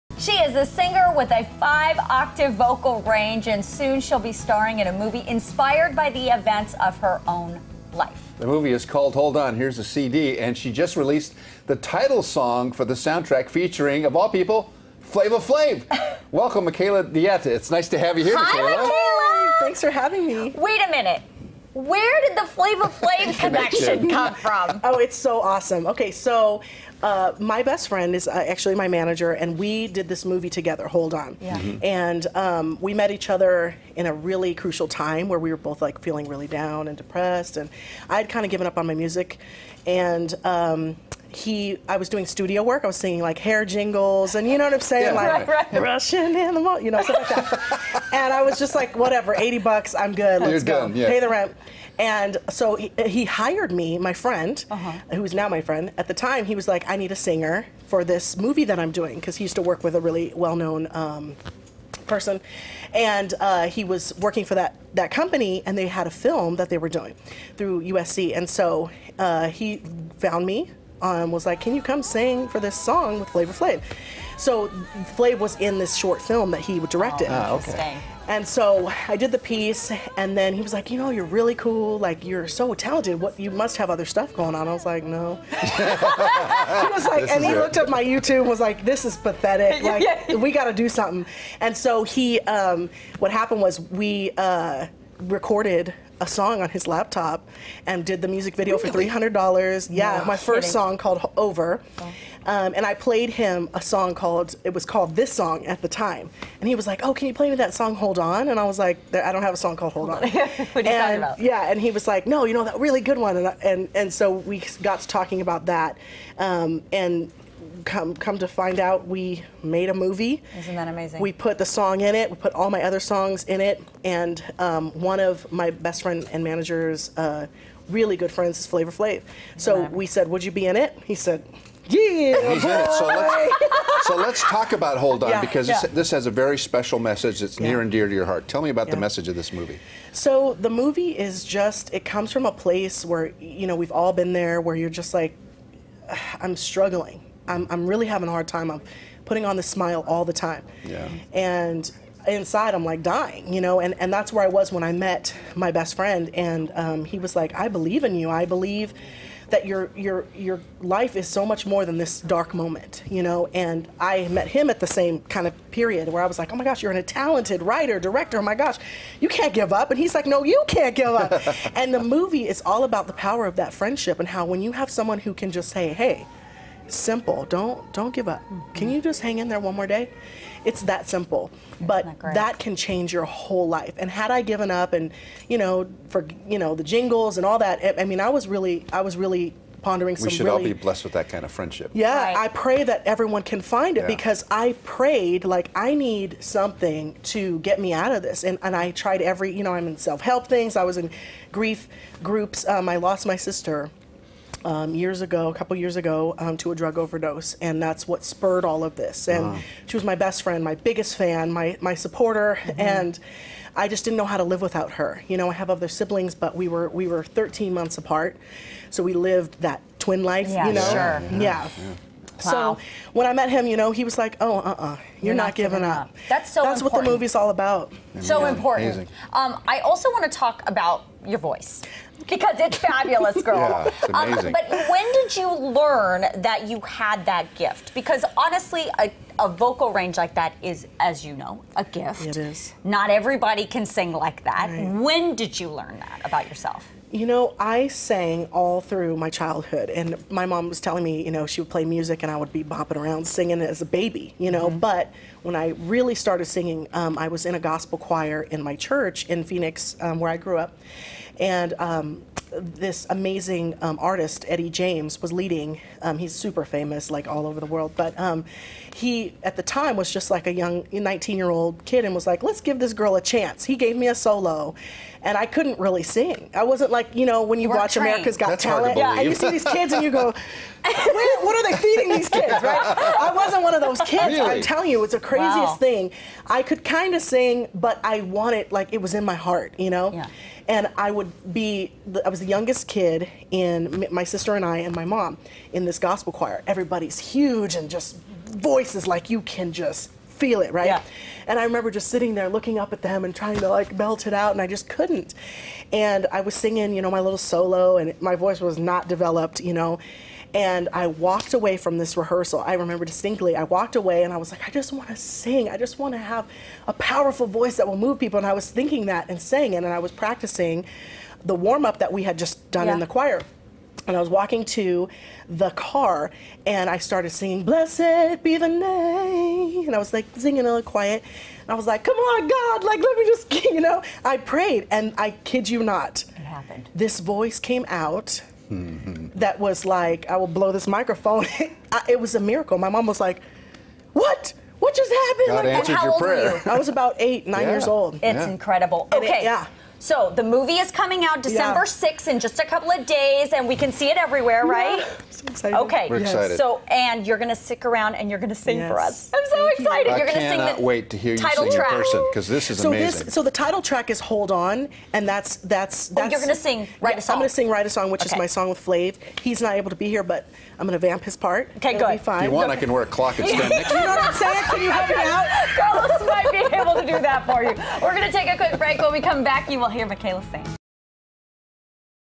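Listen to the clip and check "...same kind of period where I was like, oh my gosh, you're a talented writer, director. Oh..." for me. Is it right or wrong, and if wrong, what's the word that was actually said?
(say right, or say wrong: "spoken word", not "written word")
right.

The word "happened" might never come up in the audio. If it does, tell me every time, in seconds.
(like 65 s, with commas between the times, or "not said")
93 s, 336 s, 345 s.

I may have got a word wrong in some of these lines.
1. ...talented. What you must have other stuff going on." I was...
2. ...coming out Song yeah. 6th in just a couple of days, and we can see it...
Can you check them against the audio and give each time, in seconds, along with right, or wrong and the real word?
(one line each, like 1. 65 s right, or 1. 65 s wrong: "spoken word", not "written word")
1. 82 s right
2. 350 s wrong: "December", not "Song".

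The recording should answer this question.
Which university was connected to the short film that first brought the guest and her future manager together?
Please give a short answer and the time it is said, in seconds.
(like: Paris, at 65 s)
USC, at 67 s.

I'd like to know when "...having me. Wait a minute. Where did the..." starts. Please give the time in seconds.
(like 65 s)
19 s.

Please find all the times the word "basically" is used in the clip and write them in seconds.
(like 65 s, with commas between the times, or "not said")
not said.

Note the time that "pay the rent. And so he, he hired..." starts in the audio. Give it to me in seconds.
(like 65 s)
51 s.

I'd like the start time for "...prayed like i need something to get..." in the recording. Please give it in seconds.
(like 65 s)
194 s.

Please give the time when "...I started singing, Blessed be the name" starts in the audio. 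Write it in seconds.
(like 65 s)
326 s.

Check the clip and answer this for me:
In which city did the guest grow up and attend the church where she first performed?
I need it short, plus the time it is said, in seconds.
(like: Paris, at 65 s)
Phoenix, at 259 s.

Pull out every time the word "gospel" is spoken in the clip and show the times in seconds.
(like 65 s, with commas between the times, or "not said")
257 s, 295 s.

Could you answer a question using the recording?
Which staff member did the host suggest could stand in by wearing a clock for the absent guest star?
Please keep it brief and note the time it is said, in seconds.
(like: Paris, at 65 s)
Carlos, at 375 s.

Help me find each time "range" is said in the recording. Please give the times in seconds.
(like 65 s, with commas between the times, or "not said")
3 s, 239 s.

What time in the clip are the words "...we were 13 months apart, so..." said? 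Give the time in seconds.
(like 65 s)
216 s.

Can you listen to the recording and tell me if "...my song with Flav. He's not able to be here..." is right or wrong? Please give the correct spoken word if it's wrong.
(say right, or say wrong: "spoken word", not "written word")
right.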